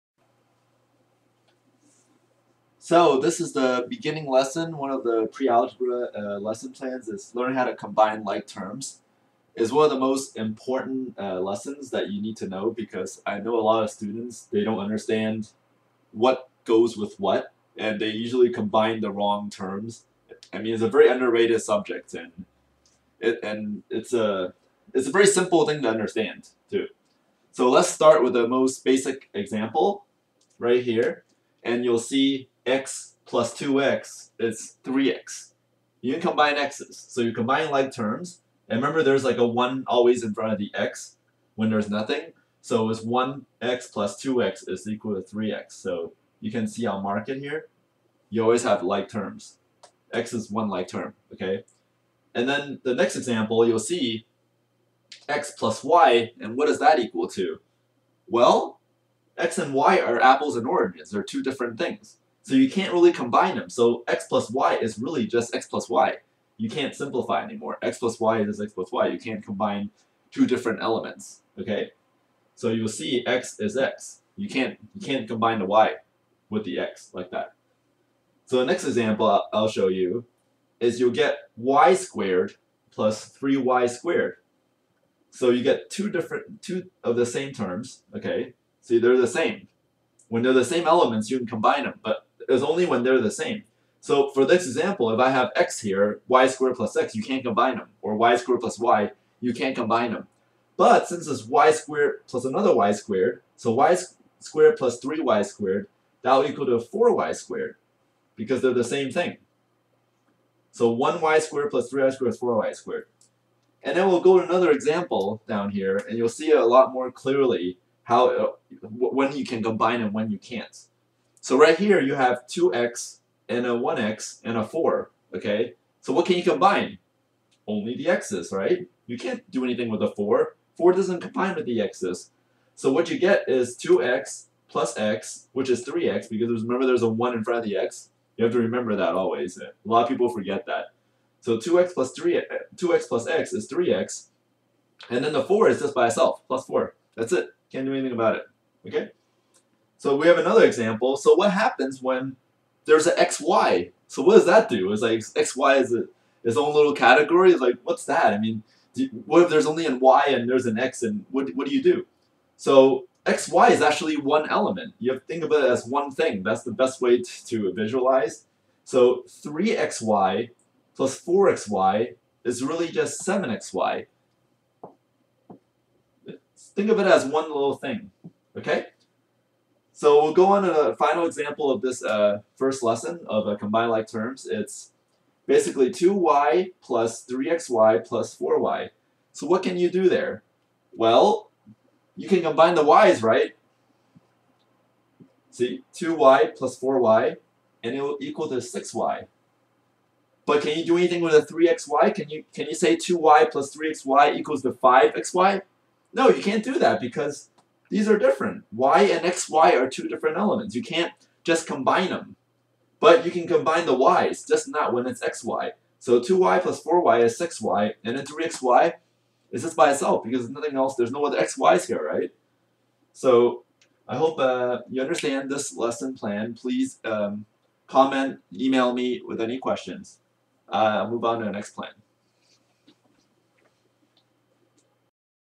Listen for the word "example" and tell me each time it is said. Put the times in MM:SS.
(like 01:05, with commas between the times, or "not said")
00:29, 00:53, 01:18, 01:34, 01:54, 02:30, 03:01.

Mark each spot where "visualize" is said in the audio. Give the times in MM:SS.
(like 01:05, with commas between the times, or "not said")
02:47.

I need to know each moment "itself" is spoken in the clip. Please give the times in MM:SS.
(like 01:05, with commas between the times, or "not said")
02:26, 03:39.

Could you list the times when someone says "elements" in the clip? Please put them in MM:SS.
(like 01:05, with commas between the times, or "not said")
01:10, 01:30, 02:44, 03:30.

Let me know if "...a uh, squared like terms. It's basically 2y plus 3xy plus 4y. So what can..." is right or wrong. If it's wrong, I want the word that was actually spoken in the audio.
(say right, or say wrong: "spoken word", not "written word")
wrong: "combined", not "squared".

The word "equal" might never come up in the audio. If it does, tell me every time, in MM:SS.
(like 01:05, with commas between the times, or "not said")
00:44, 00:56, 01:46, 03:18, 03:24.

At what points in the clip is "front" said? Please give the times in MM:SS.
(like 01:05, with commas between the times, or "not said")
00:40, 02:17.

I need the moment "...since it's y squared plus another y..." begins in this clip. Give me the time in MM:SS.
01:41.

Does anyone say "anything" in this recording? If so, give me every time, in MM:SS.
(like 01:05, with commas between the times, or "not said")
02:09, 02:27, 03:20.